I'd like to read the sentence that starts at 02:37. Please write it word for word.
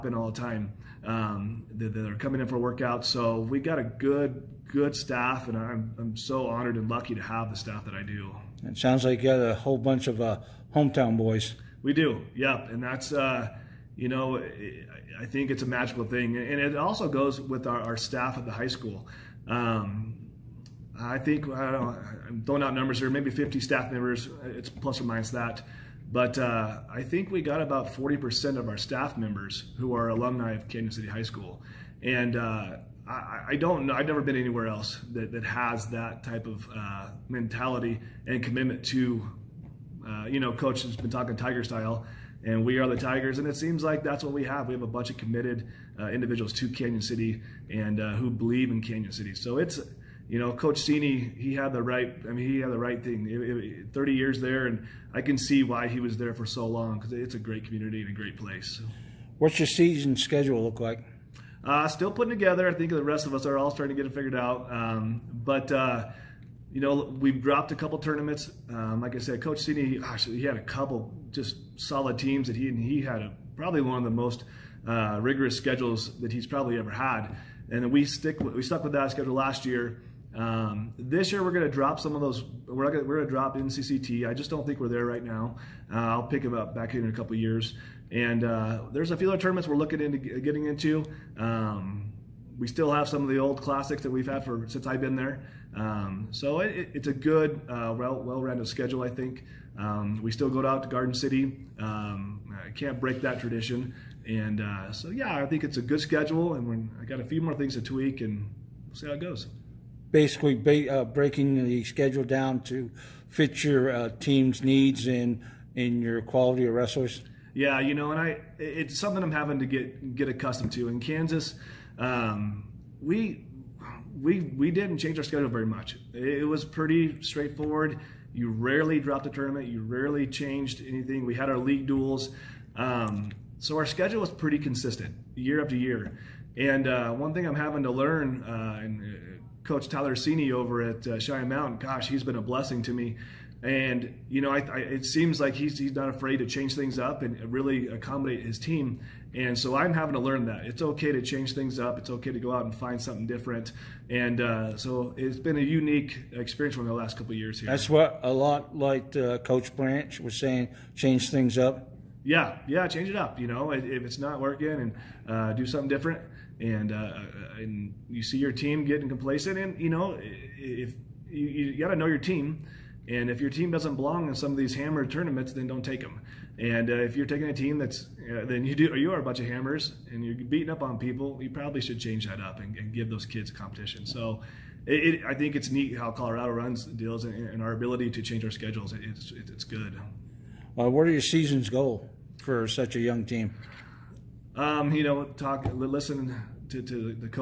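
That's what a lot like uh, Coach Branch was saying: change things up.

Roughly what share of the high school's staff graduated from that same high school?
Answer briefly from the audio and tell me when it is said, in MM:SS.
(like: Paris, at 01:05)
40%, at 00:27.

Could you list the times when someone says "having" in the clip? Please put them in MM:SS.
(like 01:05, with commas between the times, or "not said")
01:59, 02:17, 02:29.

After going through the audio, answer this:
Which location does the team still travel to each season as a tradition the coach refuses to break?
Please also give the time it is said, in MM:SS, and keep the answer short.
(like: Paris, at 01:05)
Garden City, at 01:40.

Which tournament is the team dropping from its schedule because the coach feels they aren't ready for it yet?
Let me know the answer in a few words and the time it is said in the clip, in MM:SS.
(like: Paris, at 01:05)
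NCCT, at 01:23.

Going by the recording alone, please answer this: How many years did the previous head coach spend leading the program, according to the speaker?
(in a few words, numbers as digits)
30.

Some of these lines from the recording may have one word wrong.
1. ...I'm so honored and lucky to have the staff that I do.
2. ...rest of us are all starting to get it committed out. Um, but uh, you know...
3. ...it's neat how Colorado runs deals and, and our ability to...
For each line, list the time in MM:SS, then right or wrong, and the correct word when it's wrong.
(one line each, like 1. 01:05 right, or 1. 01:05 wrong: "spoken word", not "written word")
1. 00:05 right
2. 01:03 wrong: "figured", not "committed"
3. 03:05 right.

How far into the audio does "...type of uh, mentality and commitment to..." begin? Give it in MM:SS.
00:36.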